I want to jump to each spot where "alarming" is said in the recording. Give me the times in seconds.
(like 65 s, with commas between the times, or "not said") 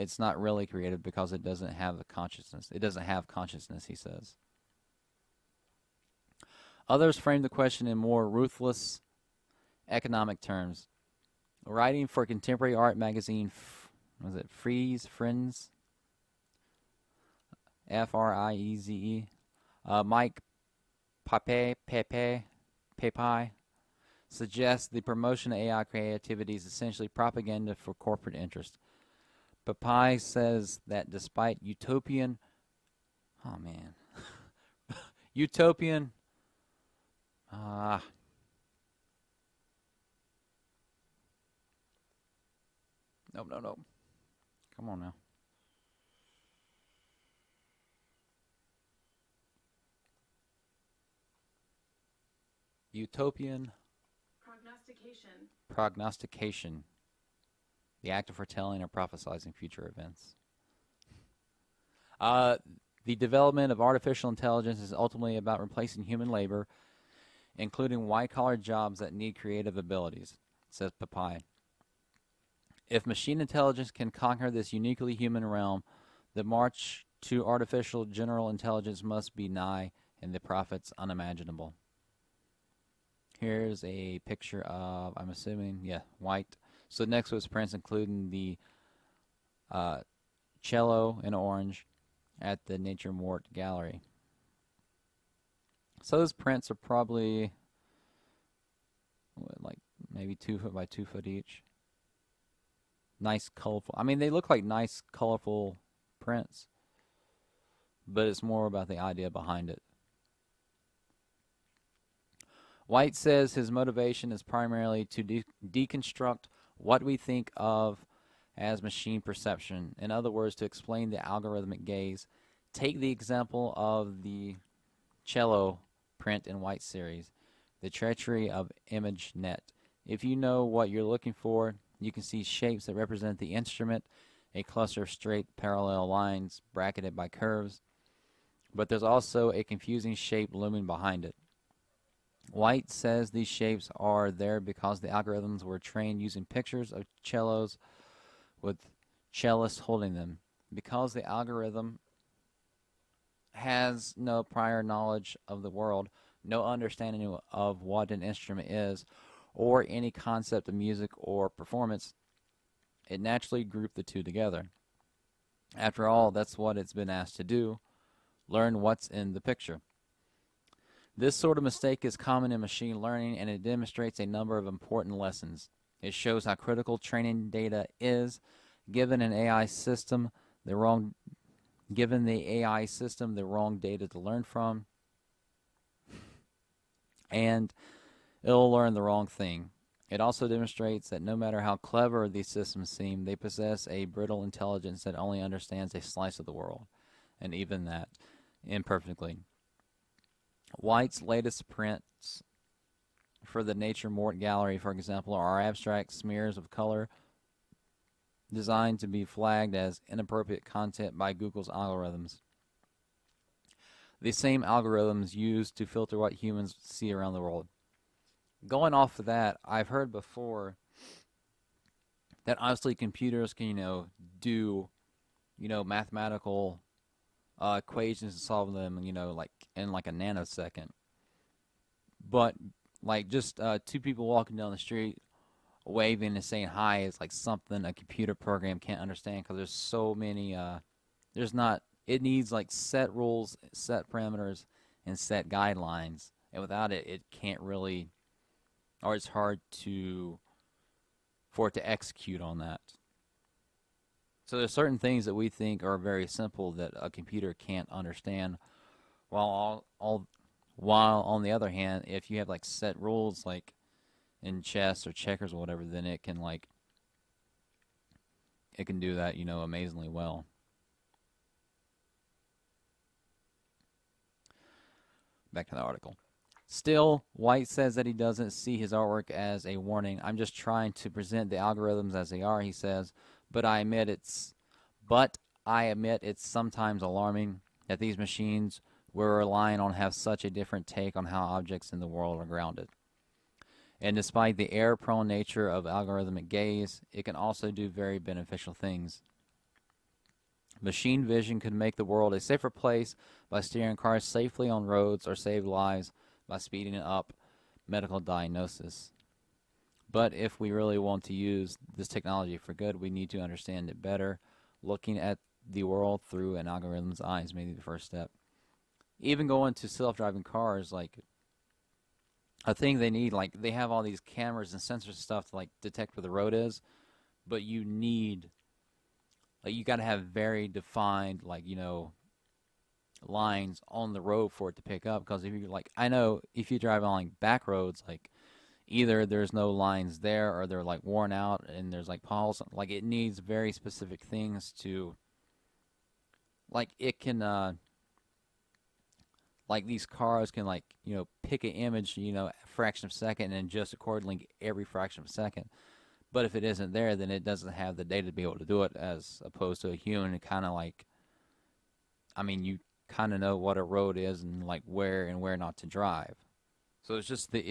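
287 s.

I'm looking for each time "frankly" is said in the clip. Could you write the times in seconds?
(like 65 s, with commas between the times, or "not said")
not said.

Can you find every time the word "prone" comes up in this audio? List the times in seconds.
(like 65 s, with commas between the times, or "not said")
294 s.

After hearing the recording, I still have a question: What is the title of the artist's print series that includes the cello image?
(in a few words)
The Treachery of ImageNet.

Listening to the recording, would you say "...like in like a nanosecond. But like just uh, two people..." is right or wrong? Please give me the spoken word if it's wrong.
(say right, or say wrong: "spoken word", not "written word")
right.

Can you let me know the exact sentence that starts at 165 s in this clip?
After all, that's what it's been asked to do learn what's in the picture.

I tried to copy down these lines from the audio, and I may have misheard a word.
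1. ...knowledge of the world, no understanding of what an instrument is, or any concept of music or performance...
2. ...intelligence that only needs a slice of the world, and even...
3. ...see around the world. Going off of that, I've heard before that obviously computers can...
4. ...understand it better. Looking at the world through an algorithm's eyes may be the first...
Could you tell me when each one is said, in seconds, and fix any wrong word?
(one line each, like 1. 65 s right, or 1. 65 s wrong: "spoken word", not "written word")
1. 154 s right
2. 194 s wrong: "understands", not "needs"
3. 216 s right
4. 313 s right.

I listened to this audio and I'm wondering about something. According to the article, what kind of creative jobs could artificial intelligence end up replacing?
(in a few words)
White collar jobs.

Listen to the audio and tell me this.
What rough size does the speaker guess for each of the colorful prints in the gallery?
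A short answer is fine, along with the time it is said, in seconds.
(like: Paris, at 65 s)
2 foot by 2 foot, at 100 s.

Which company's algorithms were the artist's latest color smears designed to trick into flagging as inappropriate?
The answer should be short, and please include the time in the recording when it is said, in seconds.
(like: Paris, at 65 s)
Google's, at 211 s.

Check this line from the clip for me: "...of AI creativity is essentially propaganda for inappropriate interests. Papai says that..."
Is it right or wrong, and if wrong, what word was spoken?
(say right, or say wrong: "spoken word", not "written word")
wrong: "corporate", not "inappropriate".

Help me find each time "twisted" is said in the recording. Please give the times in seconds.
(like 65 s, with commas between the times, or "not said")
not said.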